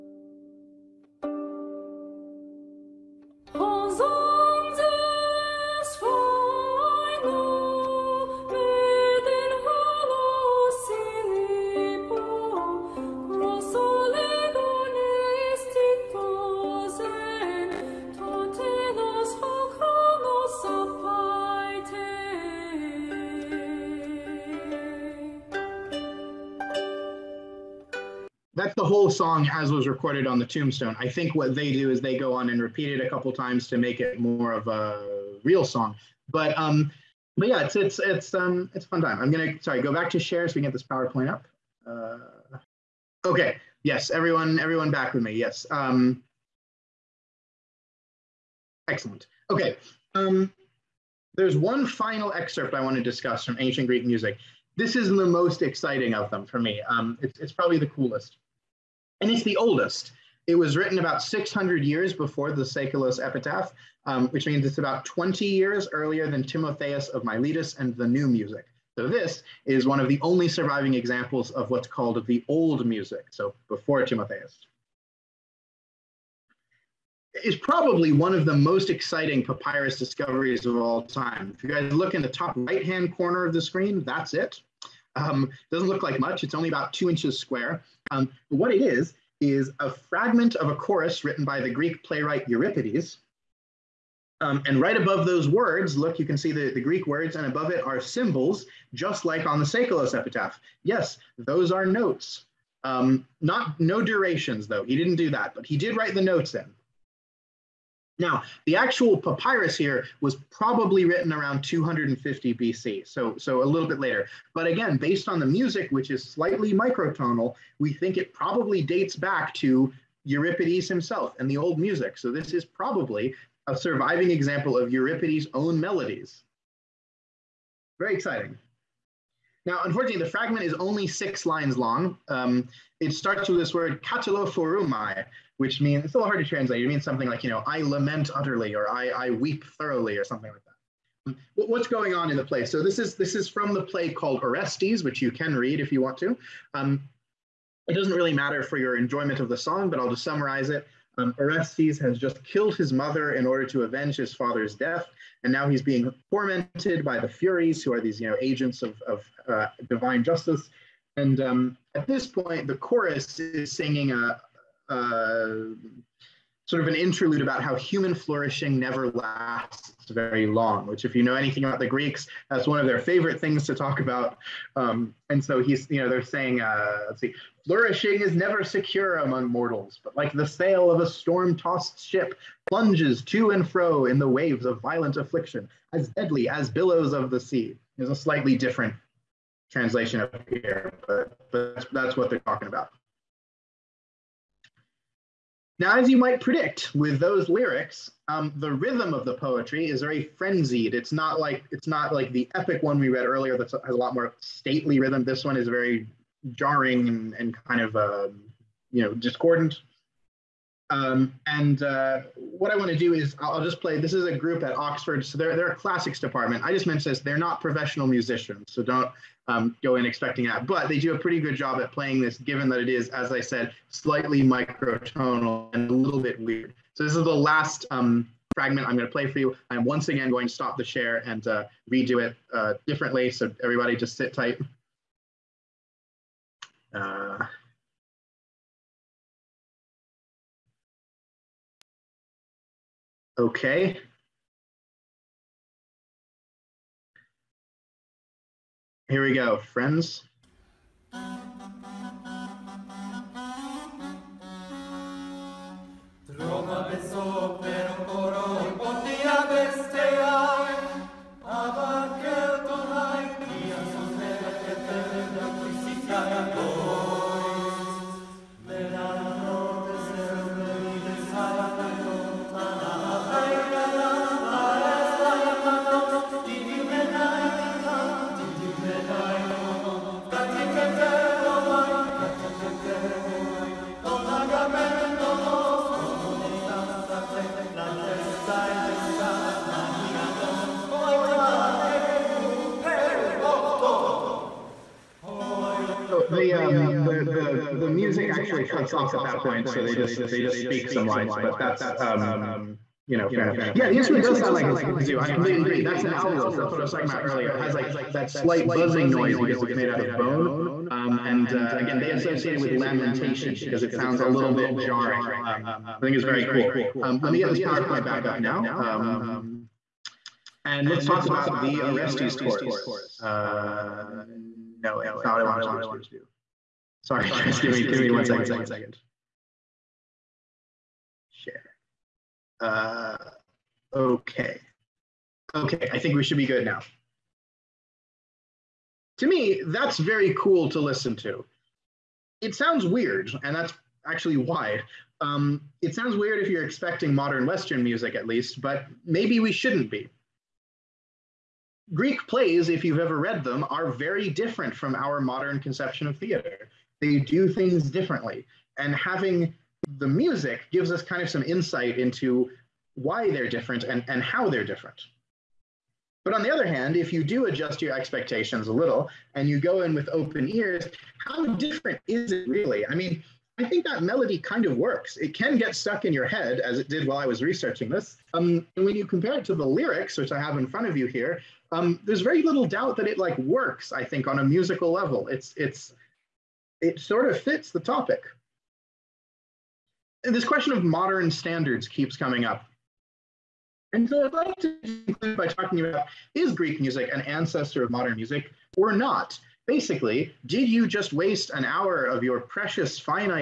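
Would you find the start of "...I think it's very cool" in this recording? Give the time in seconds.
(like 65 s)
316 s.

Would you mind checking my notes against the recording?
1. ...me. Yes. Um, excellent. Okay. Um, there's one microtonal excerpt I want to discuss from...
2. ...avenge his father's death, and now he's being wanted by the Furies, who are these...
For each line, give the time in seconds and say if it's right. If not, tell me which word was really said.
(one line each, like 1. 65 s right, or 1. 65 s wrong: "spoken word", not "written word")
1. 45 s wrong: "final", not "microtonal"
2. 153 s wrong: "tormented", not "wanted".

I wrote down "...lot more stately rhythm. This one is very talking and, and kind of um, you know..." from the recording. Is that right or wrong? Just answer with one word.
wrong.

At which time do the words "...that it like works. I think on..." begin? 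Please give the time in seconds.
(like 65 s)
382 s.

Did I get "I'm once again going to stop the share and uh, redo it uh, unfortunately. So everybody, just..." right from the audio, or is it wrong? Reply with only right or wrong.
wrong.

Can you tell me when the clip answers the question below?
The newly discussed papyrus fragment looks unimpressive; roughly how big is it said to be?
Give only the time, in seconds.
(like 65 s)
86 s.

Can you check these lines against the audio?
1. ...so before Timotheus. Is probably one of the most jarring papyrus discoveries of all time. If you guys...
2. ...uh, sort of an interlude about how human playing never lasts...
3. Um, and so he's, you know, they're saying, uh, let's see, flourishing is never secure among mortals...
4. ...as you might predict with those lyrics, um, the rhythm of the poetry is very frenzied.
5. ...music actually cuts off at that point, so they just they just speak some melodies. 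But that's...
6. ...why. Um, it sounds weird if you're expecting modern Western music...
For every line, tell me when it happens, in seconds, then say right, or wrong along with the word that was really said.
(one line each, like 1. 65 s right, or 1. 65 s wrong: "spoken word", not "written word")
1. 73 s wrong: "exciting", not "jarring"
2. 164 s wrong: "flourishing", not "playing"
3. 174 s right
4. 195 s right
5. 297 s wrong: "lines", not "melodies"
6. 344 s right.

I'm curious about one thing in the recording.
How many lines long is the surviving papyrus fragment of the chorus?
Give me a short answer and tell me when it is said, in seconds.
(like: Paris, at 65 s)
6, at 131 s.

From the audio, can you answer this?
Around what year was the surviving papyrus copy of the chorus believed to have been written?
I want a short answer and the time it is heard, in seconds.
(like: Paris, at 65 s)
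250 BC, at 111 s.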